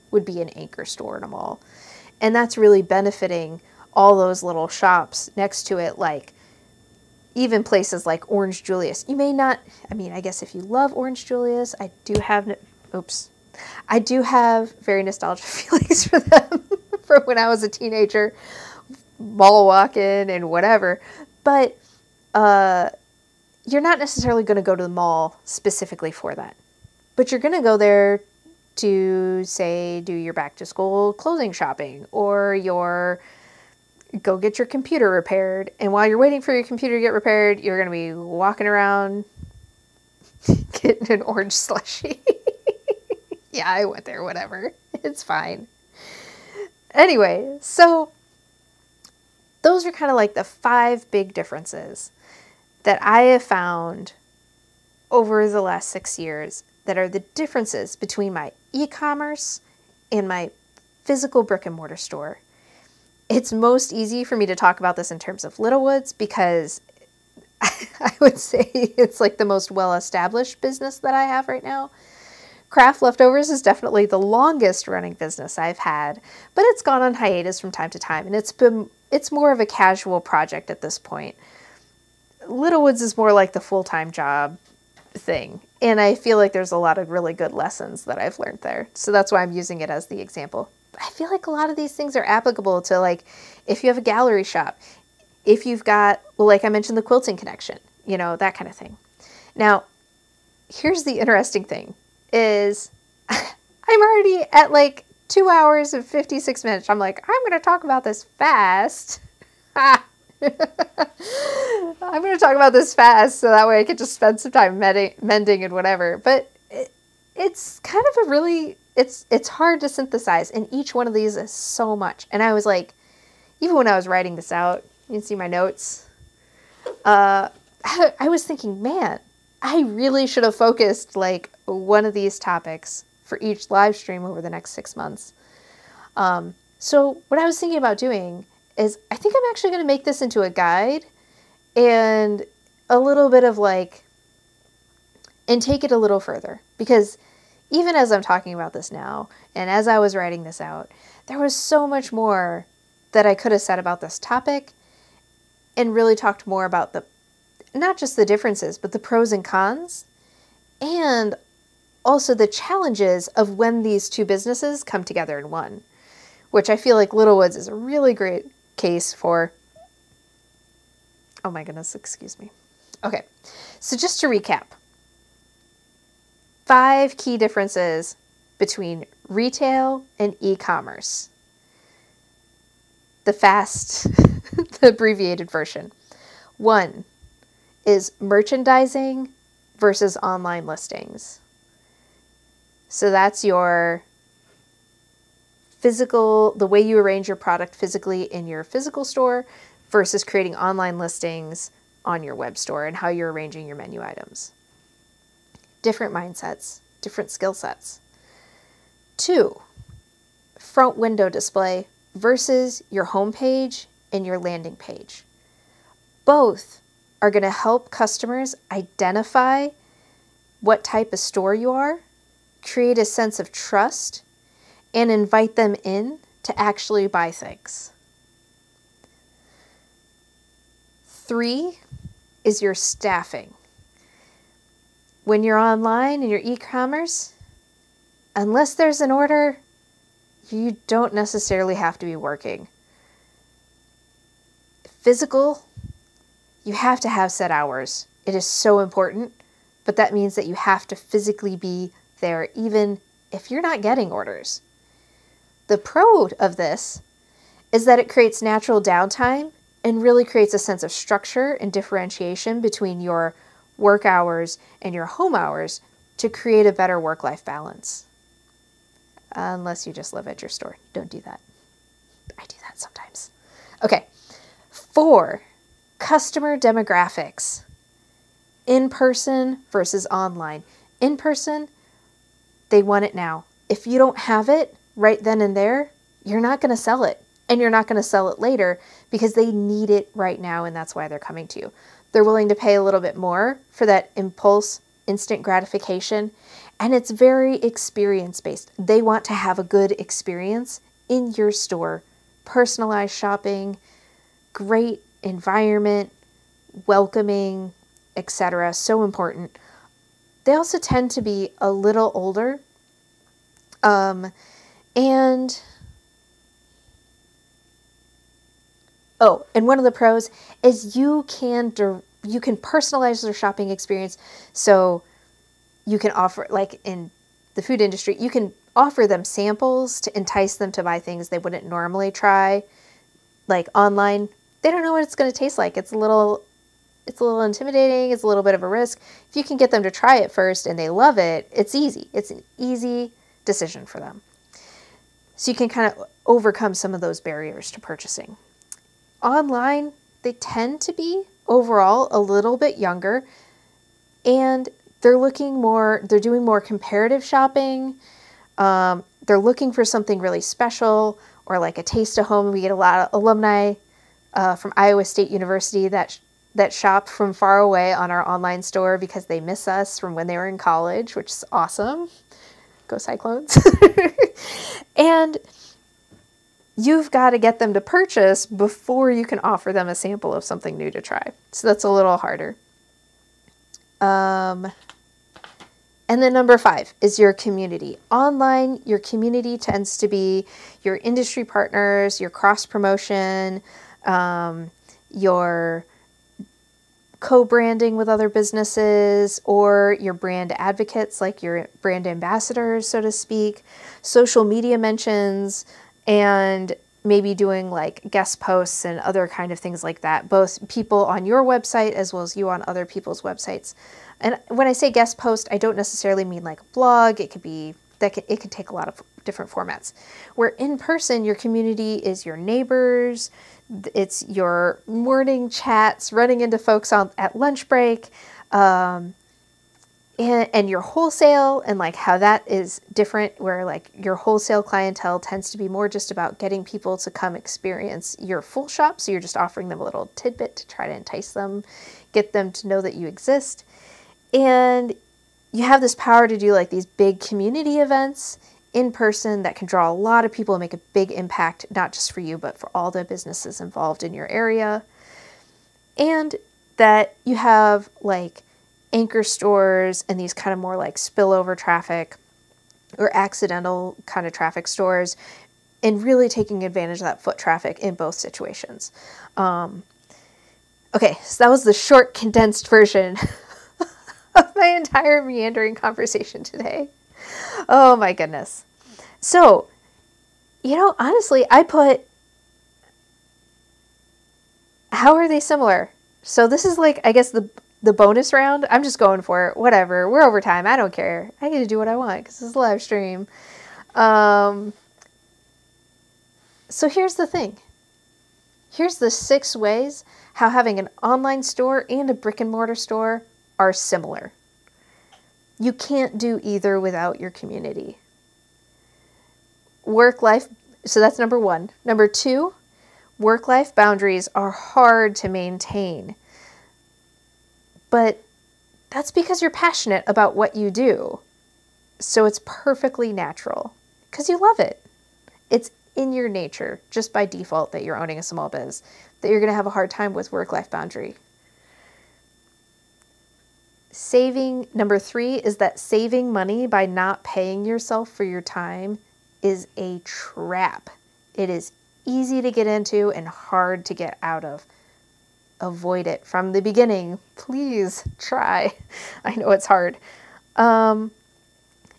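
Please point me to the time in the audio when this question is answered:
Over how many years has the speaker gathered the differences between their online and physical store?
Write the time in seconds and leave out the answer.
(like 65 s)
55 s.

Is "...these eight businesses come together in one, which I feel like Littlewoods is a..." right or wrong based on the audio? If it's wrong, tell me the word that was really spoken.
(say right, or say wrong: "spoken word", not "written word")
wrong: "two", not "eight".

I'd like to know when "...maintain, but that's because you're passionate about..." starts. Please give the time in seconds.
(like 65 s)
515 s.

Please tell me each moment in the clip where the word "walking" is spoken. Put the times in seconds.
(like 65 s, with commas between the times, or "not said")
19 s, 38 s.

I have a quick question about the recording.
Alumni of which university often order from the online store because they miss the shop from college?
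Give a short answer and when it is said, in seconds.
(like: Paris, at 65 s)
Iowa State University, at 364 s.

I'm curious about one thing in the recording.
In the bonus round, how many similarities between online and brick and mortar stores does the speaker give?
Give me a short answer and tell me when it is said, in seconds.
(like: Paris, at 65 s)
6, at 499 s.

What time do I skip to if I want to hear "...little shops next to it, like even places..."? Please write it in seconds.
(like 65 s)
4 s.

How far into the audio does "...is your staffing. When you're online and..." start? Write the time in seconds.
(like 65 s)
232 s.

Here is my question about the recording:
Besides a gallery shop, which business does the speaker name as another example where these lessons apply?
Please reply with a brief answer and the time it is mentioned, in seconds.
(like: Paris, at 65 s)
the quilting connection, at 96 s.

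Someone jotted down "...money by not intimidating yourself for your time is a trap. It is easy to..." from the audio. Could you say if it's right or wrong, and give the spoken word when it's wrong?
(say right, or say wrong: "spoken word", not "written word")
wrong: "paying", not "intimidating".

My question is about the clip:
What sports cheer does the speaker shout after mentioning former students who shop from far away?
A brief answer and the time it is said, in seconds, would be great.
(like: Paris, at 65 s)
Go Cyclones, at 372 s.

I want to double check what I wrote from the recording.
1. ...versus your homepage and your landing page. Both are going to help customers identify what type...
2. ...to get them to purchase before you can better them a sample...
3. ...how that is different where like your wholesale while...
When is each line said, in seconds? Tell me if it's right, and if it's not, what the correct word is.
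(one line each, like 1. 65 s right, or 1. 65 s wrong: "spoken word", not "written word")
1. 212 s right
2. 377 s wrong: "offer", not "better"
3. 431 s wrong: "clientele", not "while".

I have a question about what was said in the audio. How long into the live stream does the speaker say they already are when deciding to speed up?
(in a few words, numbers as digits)
2 hours and 56 minutes.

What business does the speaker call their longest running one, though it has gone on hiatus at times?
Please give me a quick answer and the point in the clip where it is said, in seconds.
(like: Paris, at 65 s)
Craft Leftovers, at 72 s.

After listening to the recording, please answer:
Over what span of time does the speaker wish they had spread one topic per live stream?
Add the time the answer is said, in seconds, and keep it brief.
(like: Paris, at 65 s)
6 months, at 134 s.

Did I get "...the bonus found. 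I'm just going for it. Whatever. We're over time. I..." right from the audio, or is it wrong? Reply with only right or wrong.
wrong.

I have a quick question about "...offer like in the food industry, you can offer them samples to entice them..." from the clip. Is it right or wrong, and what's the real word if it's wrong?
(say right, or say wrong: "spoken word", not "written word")
right.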